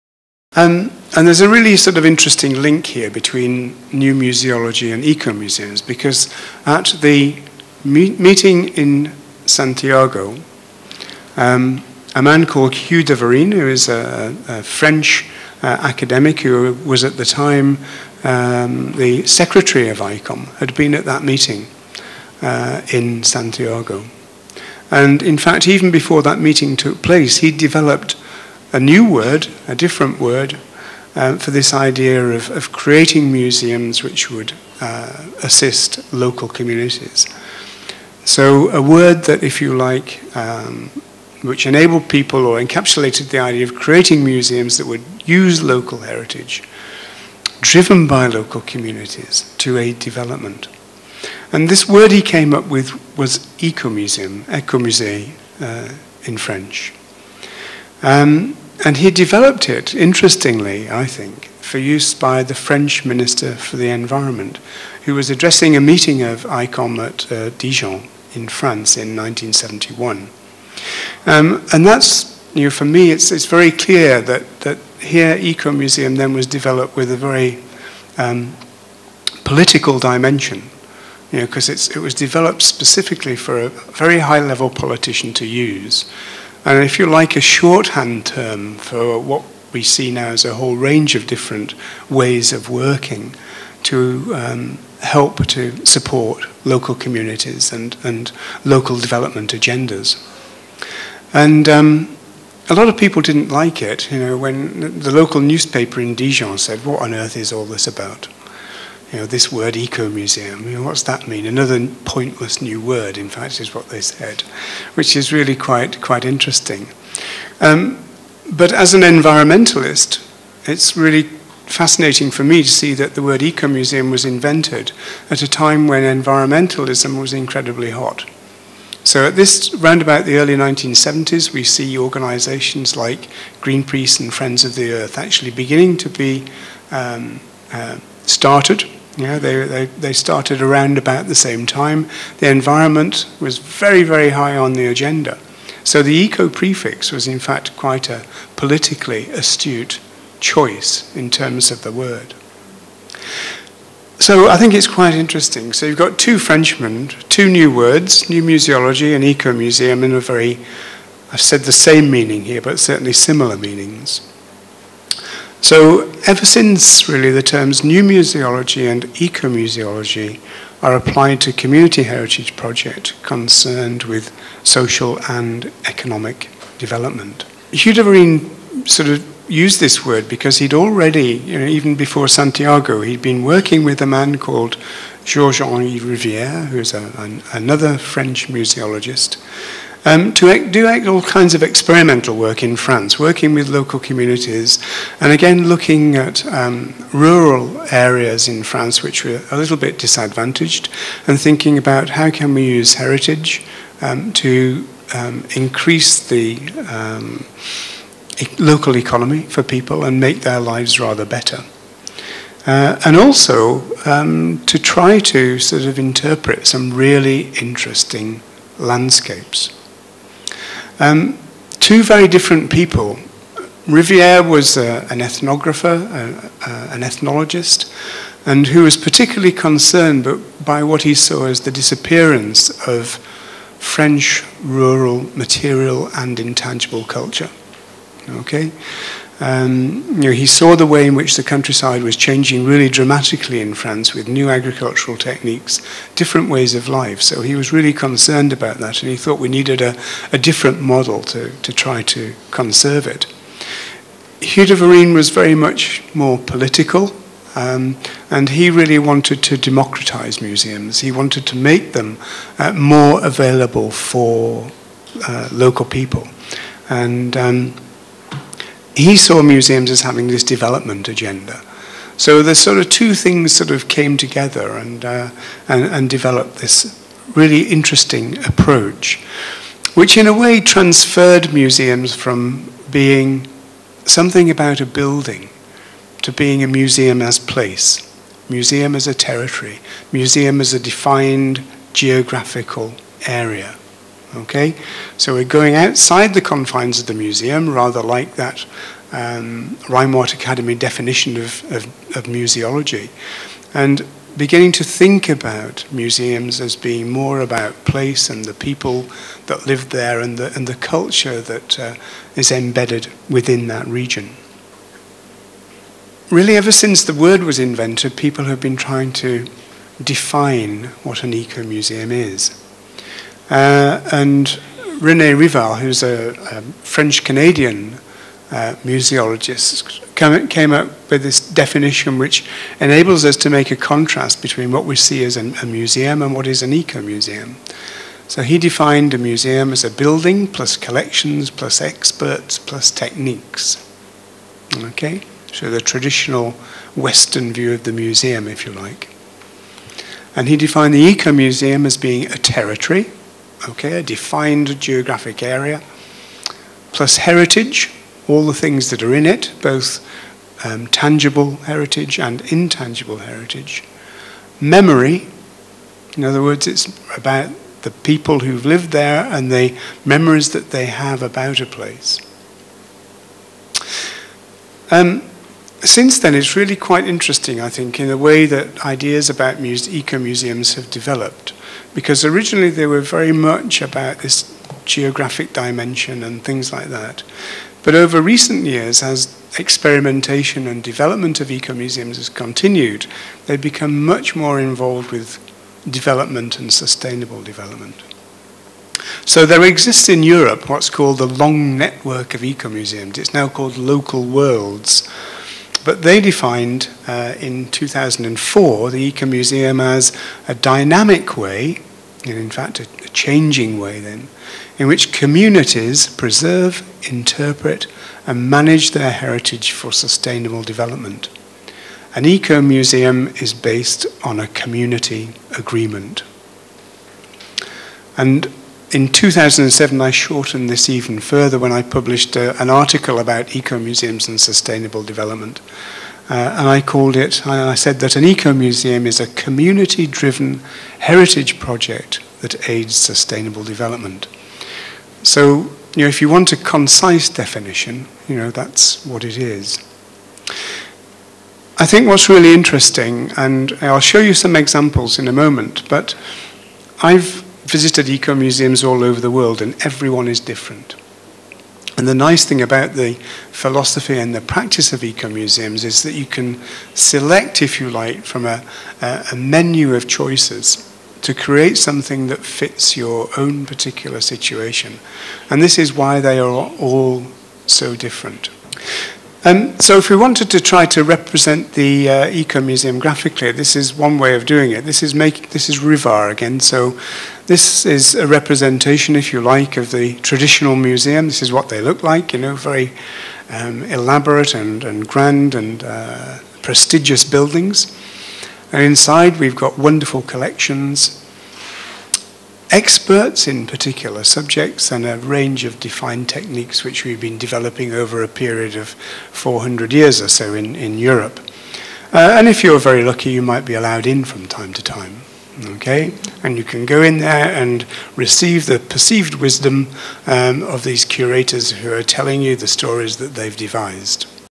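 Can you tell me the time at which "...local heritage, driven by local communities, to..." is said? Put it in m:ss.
0:45.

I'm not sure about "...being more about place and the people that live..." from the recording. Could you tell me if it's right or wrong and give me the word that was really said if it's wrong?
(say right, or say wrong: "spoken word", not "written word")
right.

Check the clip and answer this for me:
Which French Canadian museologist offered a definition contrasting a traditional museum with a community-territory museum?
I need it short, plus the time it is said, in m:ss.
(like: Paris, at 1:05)
René Rivard, at 5:25.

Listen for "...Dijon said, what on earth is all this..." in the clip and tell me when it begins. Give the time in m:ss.
1:46.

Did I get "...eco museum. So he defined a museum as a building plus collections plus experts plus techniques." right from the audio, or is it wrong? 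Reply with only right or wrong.
right.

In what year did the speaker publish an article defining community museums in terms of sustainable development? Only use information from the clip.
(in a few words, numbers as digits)
2007.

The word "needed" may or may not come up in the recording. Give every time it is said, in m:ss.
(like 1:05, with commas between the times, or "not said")
4:09.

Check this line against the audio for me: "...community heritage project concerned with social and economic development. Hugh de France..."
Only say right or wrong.
wrong.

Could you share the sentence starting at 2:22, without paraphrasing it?
The environment was very, very high on the agenda.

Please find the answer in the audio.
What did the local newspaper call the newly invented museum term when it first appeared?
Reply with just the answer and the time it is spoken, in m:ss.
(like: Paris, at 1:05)
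Another pointless new word, at 1:51.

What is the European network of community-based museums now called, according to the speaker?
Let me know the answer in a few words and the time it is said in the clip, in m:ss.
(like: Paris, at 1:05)
Local Worlds, at 6:43.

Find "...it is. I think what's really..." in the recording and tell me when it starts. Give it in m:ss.
7:29.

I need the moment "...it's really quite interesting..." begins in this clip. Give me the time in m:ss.
6:16.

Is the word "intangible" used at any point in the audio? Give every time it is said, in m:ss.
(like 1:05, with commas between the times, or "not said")
3:56, 6:02.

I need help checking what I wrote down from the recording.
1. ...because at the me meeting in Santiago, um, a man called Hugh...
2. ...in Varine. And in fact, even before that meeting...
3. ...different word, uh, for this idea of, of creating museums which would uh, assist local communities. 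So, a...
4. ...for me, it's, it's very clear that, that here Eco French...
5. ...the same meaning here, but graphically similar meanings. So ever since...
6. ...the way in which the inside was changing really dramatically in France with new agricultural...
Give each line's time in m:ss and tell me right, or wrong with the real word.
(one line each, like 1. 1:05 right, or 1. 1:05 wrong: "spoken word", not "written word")
1. 0:05 right
2. 0:22 wrong: "Santiago", not "Varine"
3. 0:29 right
4. 1:12 wrong: "Museum", not "French"
5. 2:41 wrong: "certainly", not "graphically"
6. 4:00 wrong: "countryside", not "inside".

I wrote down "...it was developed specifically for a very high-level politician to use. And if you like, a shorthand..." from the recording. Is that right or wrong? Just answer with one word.
right.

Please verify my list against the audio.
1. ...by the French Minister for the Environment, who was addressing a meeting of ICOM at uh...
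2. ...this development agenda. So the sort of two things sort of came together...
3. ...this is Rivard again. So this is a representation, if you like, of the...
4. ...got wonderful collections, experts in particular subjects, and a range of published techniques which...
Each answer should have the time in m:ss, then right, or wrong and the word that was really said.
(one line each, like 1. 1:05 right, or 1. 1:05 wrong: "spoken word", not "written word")
1. 1:02 right
2. 4:30 right
3. 8:05 right
4. 8:19 wrong: "defined", not "published".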